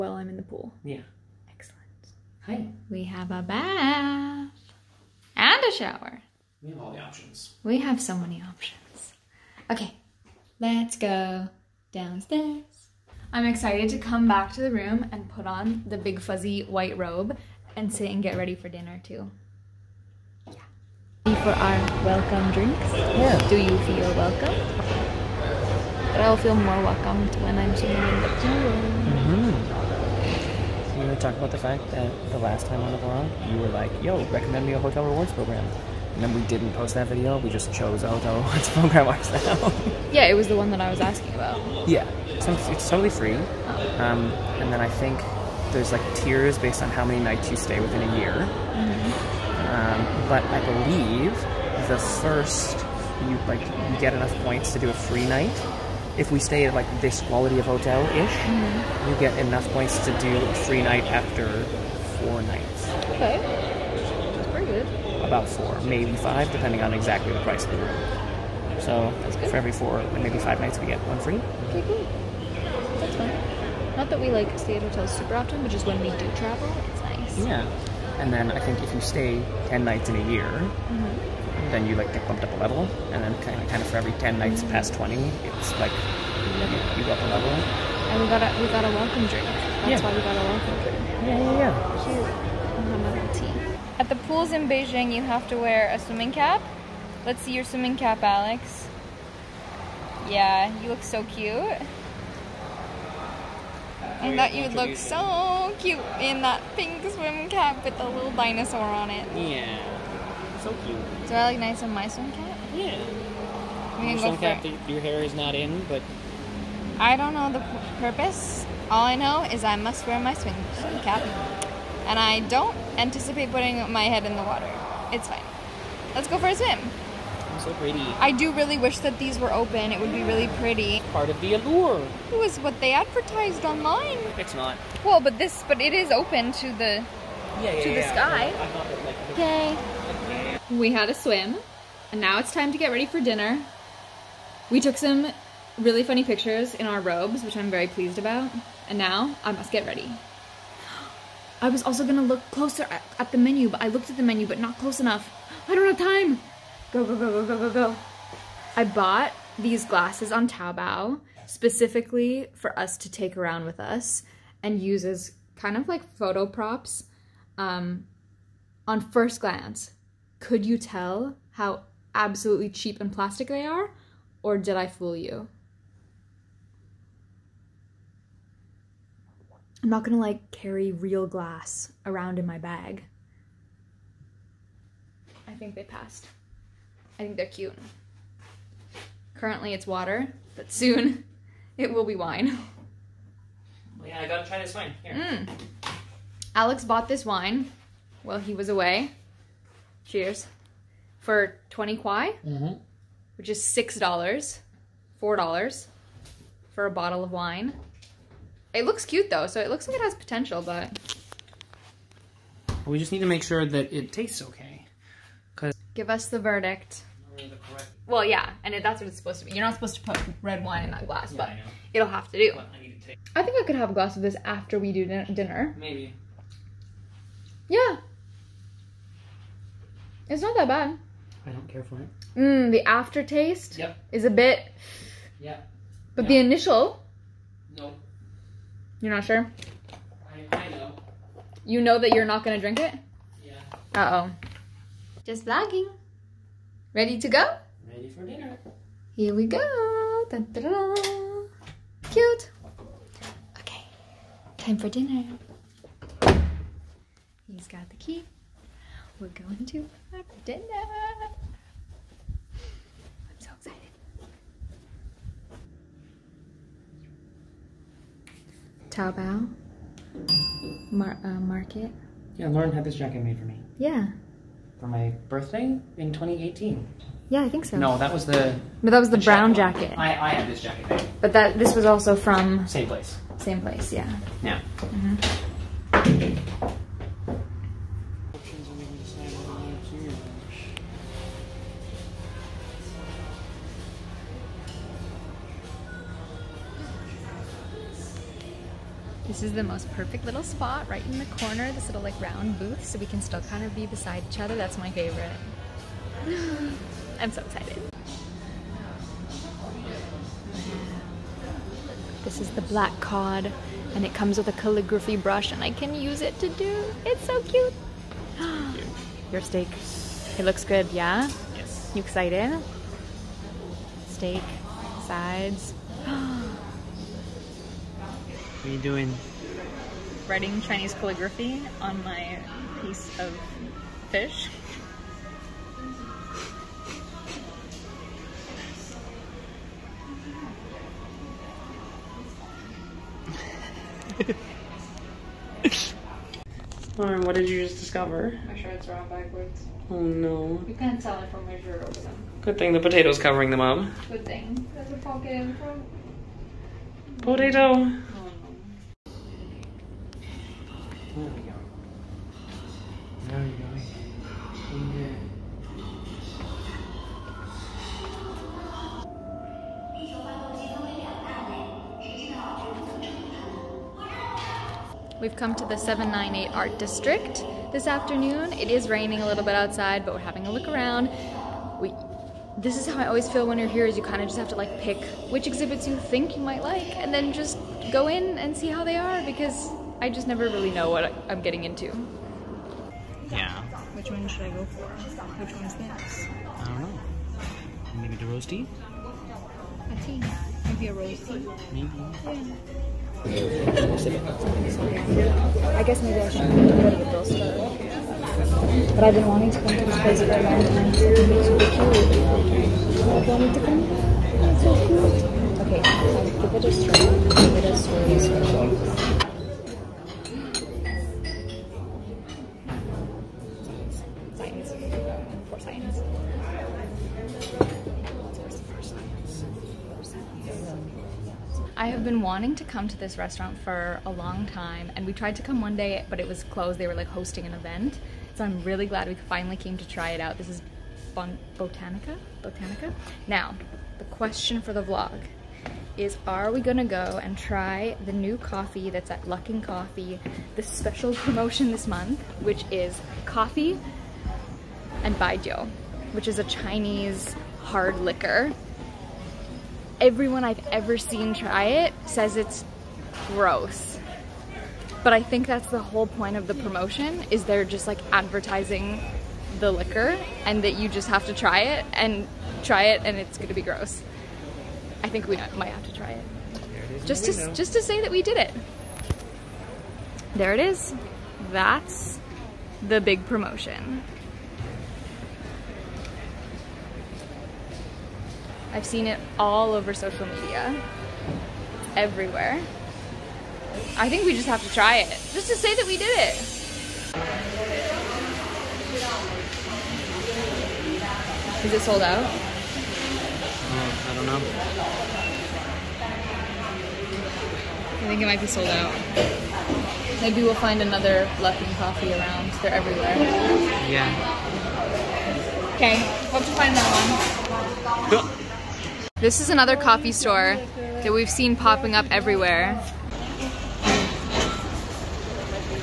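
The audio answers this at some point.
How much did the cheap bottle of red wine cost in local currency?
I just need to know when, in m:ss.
3:21.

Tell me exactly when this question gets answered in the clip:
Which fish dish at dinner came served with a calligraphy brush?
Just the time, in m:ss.
5:12.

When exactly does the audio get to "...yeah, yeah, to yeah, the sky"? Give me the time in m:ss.
2:17.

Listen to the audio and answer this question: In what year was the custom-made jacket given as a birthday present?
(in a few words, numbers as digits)
2018.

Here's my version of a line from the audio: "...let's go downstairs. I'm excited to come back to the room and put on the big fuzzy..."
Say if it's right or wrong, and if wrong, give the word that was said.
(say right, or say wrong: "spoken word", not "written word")
right.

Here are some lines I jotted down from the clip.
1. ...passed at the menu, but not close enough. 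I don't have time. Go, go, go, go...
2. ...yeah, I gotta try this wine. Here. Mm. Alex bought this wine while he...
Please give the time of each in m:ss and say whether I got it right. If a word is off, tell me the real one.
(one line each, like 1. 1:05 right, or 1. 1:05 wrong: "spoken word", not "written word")
1. 2:33 wrong: "looked", not "passed"
2. 3:14 right.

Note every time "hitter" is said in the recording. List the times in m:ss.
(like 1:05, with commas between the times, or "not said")
not said.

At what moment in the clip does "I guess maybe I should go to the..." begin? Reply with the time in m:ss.
6:43.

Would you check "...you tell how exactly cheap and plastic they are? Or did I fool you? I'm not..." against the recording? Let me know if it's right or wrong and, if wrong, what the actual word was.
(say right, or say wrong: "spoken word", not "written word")
wrong: "absolutely", not "exactly".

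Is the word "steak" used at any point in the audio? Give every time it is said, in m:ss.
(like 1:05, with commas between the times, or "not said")
5:19, 5:24.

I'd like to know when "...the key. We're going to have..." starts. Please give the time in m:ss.
4:17.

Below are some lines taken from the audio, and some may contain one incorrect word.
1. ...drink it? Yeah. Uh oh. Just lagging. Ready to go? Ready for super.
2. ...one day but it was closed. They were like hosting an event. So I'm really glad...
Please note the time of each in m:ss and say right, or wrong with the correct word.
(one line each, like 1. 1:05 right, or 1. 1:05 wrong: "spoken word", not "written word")
1. 4:02 wrong: "dinner", not "super"
2. 7:15 right.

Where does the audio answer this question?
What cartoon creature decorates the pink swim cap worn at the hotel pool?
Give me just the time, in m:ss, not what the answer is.
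1:48.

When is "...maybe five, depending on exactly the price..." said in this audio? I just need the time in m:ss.
1:05.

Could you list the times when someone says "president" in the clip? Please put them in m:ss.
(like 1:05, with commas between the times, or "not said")
not said.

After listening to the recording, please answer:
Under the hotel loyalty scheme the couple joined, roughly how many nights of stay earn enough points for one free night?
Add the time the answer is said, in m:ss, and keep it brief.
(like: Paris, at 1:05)
4, at 1:02.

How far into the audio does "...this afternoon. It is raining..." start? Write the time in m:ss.
6:17.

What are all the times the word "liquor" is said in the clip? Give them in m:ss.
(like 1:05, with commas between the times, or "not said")
7:37, 7:49.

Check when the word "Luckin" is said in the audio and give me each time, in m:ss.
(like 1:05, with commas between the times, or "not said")
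7:29, 8:31.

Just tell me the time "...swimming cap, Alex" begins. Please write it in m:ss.
1:37.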